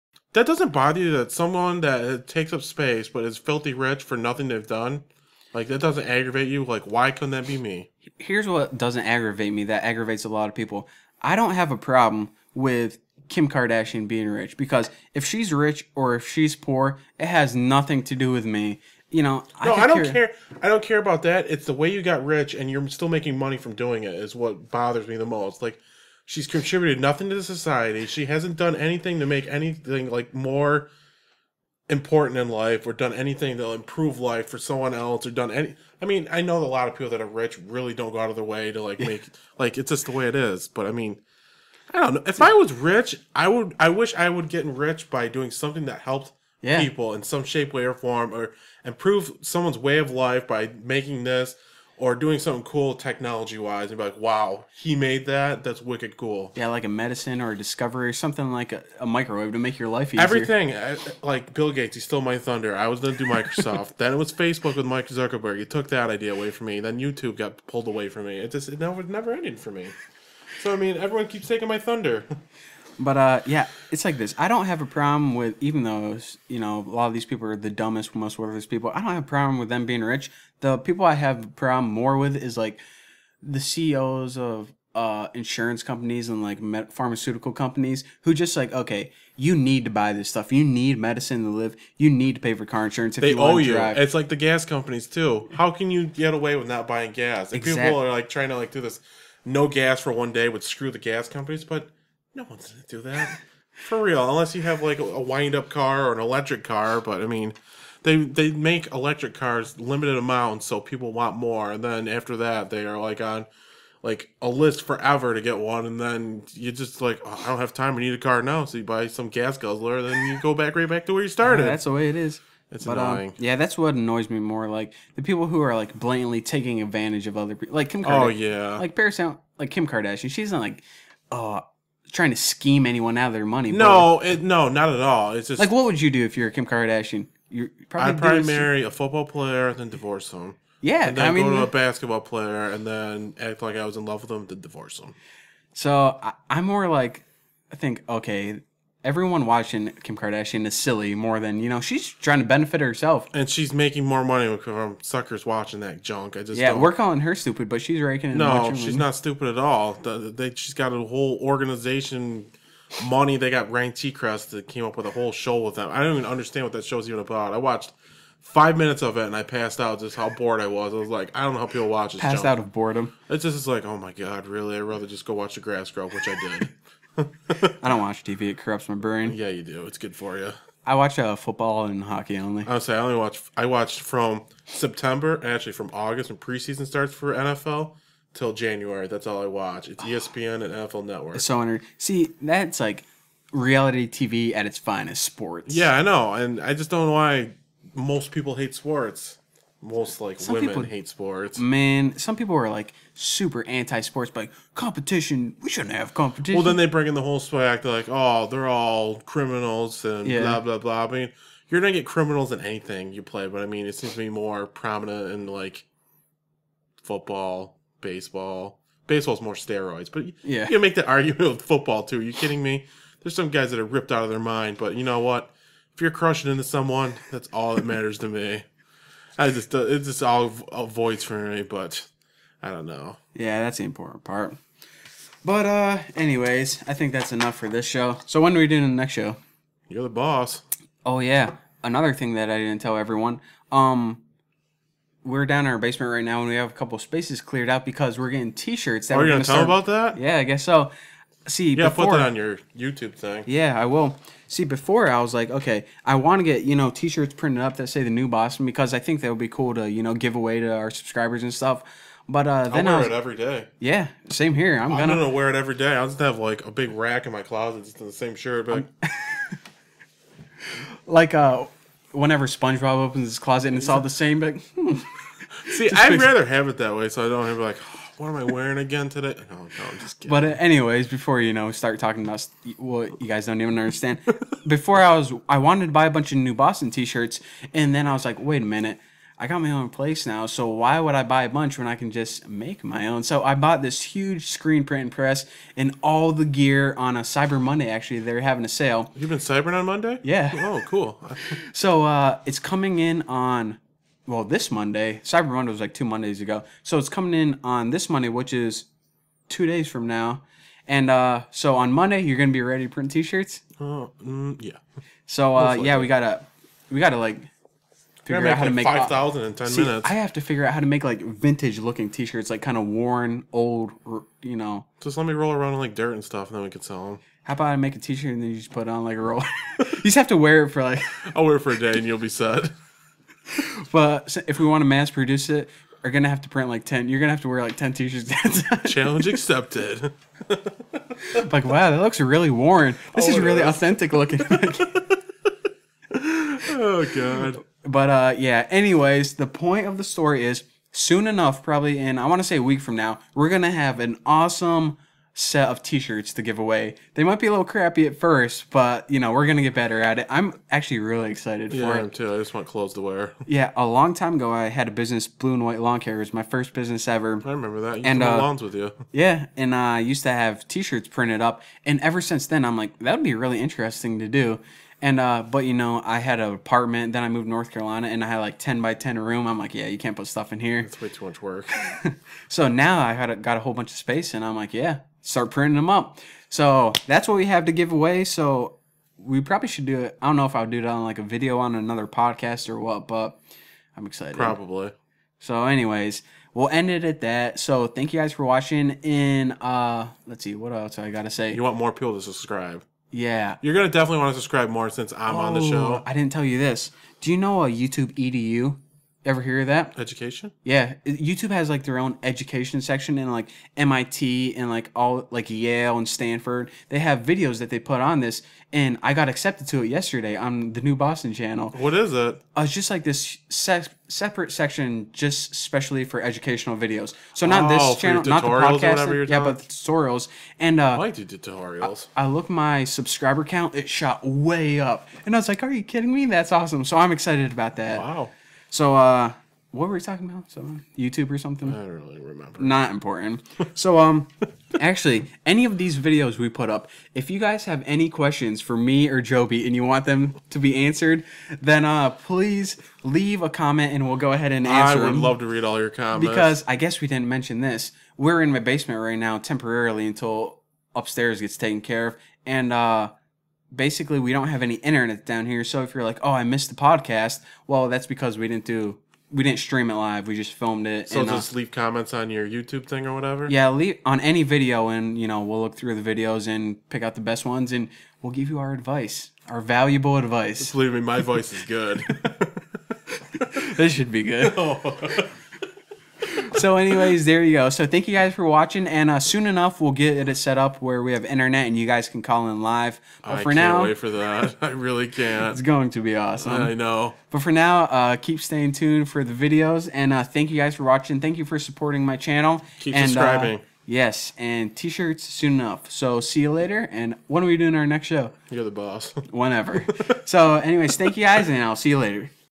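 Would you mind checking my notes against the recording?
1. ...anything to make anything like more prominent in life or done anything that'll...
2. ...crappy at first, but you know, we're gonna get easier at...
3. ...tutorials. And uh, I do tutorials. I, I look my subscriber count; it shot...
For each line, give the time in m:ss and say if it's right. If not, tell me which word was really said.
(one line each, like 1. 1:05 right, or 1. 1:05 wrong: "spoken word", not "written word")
1. 0:28 wrong: "important", not "prominent"
2. 5:57 wrong: "better", not "easier"
3. 7:09 right.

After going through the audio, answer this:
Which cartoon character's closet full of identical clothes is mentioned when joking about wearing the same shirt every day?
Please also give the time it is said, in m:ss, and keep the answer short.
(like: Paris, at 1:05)
SpongeBob, at 4:32.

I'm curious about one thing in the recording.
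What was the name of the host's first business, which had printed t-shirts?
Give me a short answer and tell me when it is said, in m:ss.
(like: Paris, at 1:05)
Blue and White Lawn Care, at 6:05.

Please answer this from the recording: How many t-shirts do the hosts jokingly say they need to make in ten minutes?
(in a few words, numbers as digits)
5000.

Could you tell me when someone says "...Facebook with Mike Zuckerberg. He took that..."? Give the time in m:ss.
1:04.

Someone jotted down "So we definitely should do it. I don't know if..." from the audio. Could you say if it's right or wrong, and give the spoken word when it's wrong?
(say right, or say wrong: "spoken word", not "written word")
wrong: "probably", not "definitely".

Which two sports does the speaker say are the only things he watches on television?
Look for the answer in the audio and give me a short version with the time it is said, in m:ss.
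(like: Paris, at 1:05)
football and hockey, at 3:01.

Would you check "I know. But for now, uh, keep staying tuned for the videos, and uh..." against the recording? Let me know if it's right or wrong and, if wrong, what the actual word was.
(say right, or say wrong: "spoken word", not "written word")
right.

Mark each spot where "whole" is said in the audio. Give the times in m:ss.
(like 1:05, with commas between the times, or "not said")
2:41, 2:45, 3:27, 6:23.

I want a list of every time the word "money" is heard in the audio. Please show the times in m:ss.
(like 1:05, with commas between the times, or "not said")
0:23, 2:13, 2:34, 2:43.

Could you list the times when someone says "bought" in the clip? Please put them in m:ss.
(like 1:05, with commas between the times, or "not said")
4:53.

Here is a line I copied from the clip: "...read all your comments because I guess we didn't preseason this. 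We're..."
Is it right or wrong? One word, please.
wrong.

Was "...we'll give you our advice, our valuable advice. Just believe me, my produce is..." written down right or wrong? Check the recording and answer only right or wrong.
wrong.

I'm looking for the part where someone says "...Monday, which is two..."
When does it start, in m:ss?
5:08.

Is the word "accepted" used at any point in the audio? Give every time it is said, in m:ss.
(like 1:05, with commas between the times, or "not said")
5:39, 6:59.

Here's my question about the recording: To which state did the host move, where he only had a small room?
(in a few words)
North Carolina.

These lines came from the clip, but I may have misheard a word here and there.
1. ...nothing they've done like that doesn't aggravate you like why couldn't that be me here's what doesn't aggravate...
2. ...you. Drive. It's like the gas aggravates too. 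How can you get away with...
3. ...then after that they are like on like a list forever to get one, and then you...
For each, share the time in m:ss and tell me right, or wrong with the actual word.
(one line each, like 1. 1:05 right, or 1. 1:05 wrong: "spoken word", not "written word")
1. 0:04 right
2. 1:33 wrong: "companies", not "aggravates"
3. 1:51 right.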